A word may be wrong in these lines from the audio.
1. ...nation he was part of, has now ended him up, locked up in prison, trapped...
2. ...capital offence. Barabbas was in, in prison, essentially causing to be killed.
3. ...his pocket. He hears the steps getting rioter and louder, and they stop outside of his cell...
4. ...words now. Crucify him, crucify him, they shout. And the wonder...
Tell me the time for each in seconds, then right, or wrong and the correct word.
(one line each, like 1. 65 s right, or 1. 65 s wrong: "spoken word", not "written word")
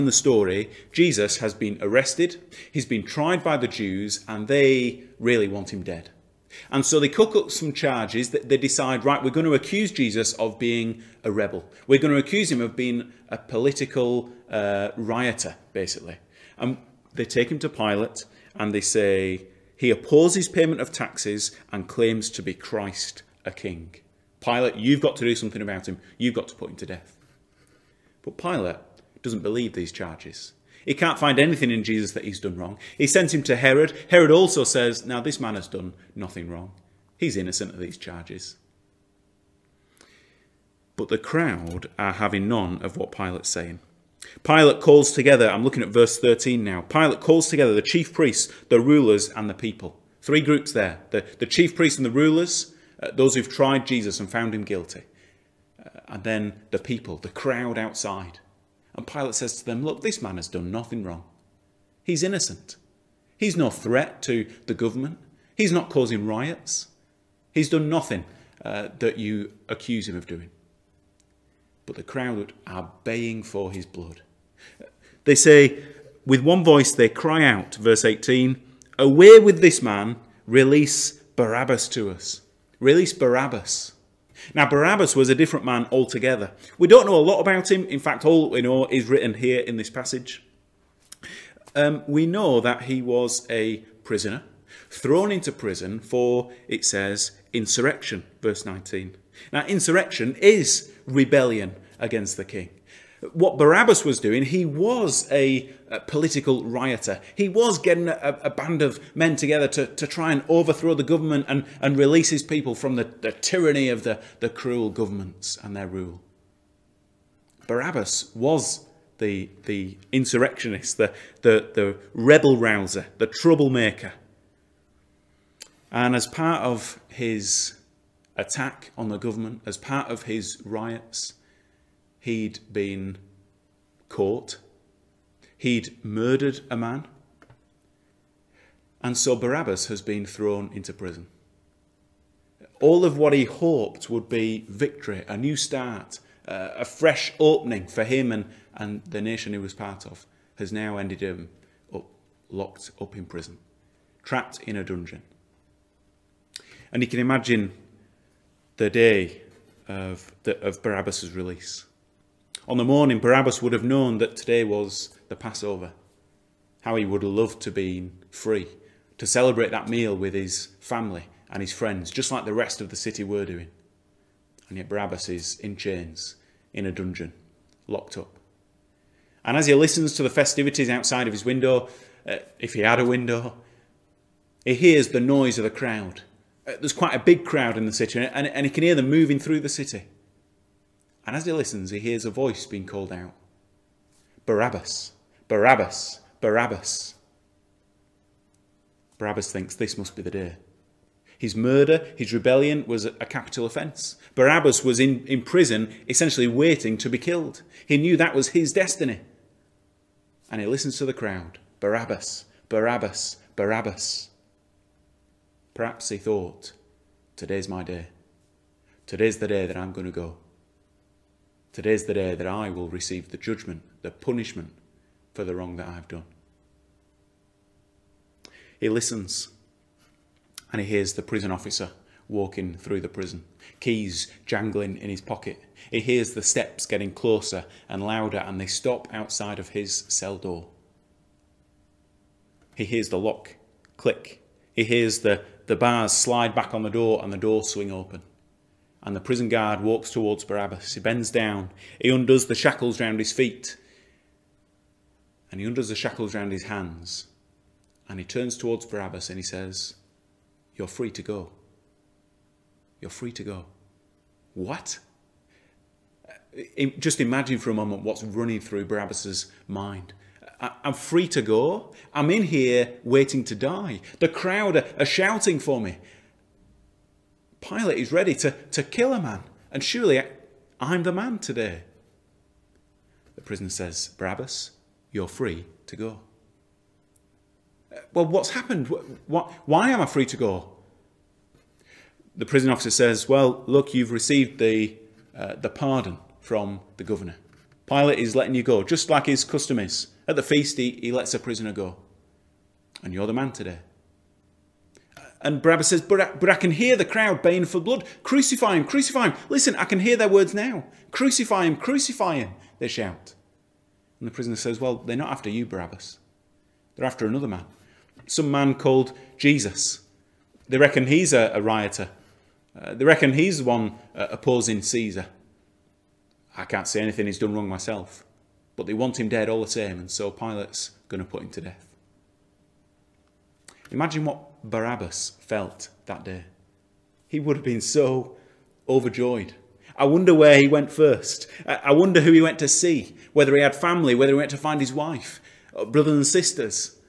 1. 149 s right
2. 203 s wrong: "waiting", not "causing"
3. 235 s wrong: "closer", not "rioter"
4. 310 s wrong: "prisoner", not "wonder".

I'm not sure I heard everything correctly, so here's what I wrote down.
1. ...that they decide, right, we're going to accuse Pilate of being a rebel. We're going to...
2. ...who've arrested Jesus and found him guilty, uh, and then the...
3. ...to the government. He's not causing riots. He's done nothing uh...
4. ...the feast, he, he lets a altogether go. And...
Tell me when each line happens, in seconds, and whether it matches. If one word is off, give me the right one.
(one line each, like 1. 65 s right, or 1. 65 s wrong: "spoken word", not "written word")
1. 8 s wrong: "Jesus", not "Pilate"
2. 53 s wrong: "tried", not "arrested"
3. 64 s right
4. 300 s wrong: "prisoner", not "altogether".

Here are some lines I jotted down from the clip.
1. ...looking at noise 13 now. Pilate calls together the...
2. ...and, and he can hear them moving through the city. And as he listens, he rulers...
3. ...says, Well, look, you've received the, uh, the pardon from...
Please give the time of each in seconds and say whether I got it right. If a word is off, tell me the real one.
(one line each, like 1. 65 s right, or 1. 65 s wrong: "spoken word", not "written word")
1. 45 s wrong: "verse", not "noise"
2. 188 s wrong: "hears", not "rulers"
3. 292 s right.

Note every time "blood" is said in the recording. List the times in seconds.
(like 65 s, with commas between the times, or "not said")
73 s, 307 s.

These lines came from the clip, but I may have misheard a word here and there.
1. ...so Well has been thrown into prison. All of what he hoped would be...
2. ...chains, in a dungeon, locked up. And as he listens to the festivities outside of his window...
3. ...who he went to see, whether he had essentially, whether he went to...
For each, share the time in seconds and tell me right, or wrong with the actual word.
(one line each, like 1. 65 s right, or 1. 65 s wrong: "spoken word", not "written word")
1. 139 s wrong: "Barabbas", not "Well"
2. 175 s right
3. 342 s wrong: "family", not "essentially".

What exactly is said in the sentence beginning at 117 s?
Barabbas was the, the insurrectionist, the, the, the rebel rouser, the troublemaker.